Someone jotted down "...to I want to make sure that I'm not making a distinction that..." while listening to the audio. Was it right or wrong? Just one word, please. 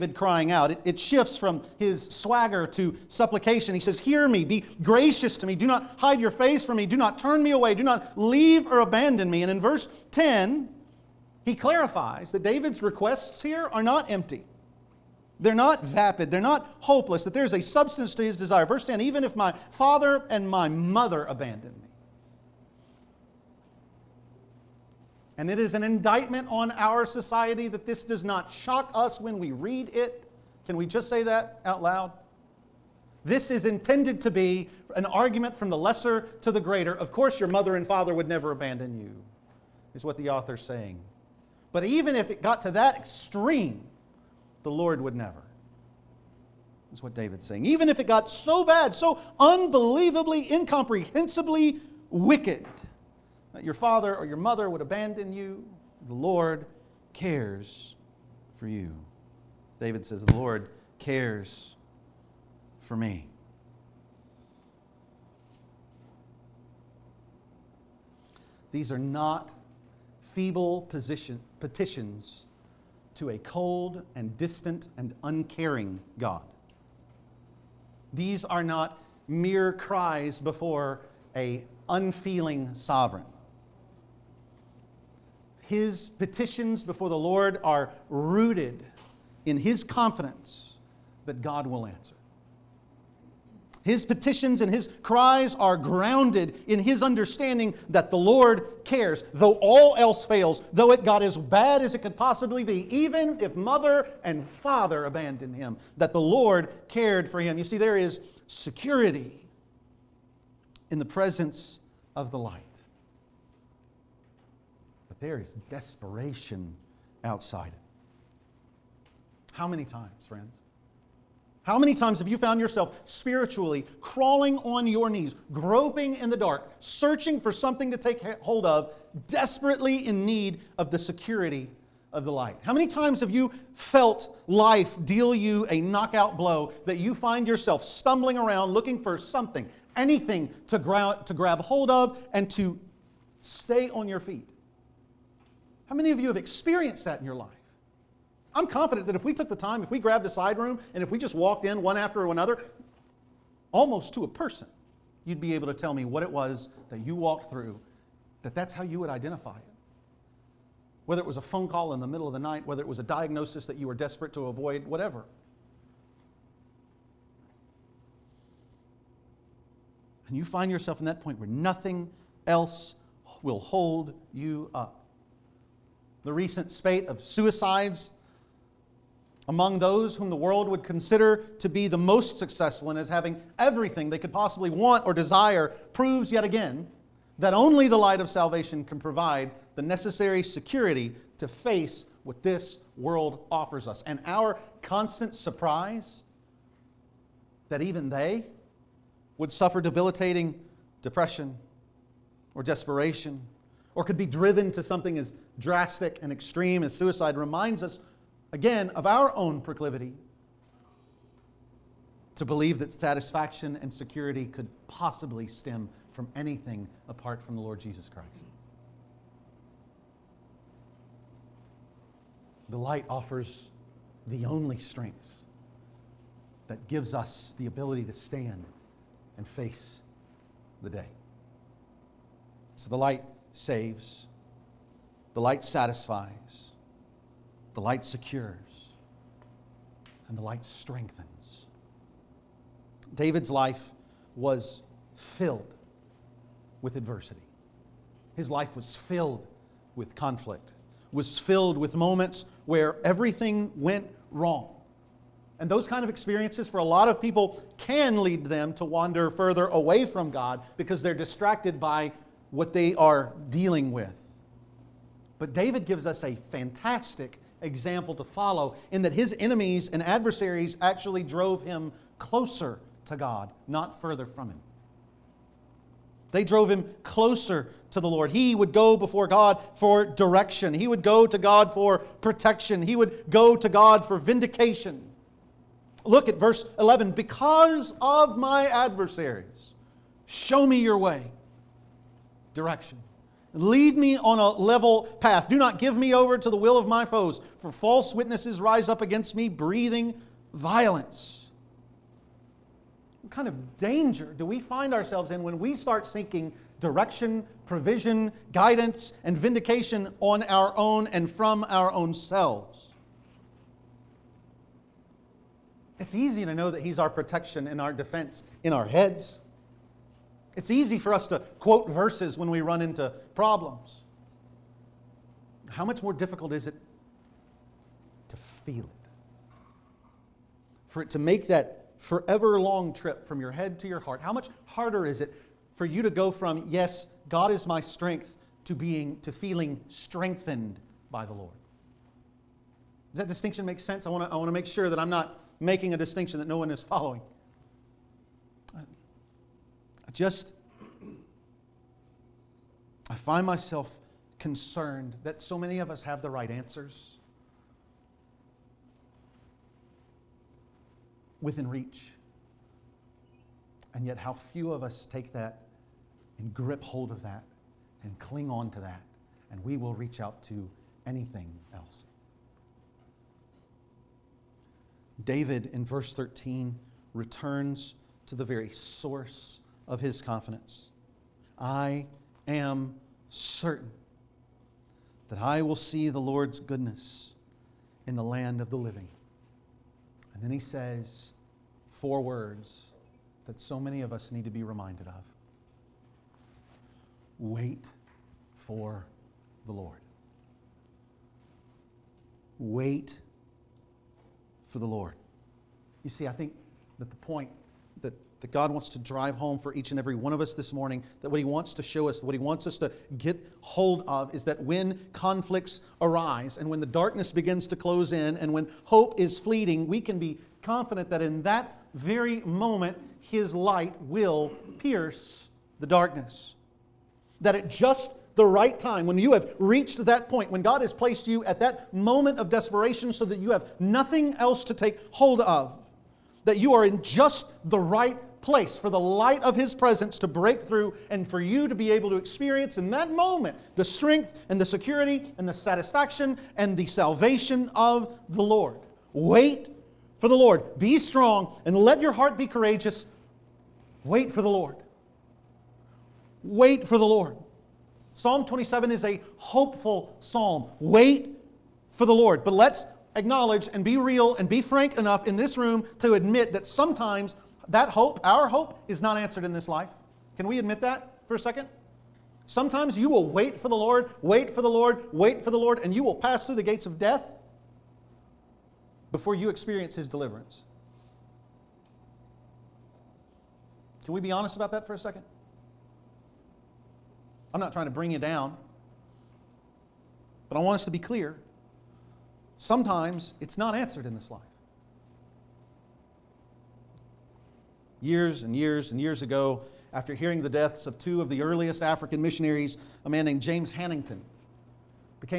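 right.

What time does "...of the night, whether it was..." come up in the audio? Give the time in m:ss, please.
2:42.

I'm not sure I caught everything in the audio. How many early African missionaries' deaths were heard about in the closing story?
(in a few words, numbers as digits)
2.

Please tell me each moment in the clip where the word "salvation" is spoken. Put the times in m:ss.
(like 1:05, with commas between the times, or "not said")
3:08, 7:26.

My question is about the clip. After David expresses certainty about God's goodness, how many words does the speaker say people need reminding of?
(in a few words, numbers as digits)
4.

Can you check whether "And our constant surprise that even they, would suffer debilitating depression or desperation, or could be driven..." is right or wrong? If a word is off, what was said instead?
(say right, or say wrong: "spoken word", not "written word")
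right.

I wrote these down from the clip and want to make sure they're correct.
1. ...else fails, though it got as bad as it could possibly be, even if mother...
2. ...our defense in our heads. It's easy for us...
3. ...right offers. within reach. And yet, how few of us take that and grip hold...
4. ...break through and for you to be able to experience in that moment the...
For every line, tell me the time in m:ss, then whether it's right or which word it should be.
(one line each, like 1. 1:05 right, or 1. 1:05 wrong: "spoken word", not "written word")
1. 1:39 right
2. 5:17 right
3. 5:56 wrong: "answers", not "offers"
4. 7:20 right.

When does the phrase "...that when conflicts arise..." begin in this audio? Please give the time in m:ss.
6:54.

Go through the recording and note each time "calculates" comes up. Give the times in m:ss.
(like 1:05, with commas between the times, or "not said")
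not said.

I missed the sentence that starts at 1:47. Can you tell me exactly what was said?
You see, there is security in the presence of the light.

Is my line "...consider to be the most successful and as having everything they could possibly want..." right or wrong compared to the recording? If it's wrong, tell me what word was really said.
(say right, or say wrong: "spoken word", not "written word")
right.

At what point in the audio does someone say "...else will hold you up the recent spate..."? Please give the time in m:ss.
2:52.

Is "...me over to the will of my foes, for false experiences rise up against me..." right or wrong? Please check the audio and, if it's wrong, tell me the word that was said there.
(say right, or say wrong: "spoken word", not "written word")
wrong: "witnesses", not "experiences".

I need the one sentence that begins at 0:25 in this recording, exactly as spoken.
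And it is an indictment on our society that this does not shock us when we read it.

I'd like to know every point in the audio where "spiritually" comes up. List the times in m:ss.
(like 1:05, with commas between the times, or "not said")
2:03.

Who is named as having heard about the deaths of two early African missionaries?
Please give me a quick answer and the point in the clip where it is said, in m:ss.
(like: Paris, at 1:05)
James Hannington, at 8:23.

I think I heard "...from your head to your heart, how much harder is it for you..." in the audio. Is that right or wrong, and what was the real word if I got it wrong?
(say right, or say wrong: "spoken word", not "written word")
right.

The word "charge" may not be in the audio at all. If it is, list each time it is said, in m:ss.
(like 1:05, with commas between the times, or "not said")
not said.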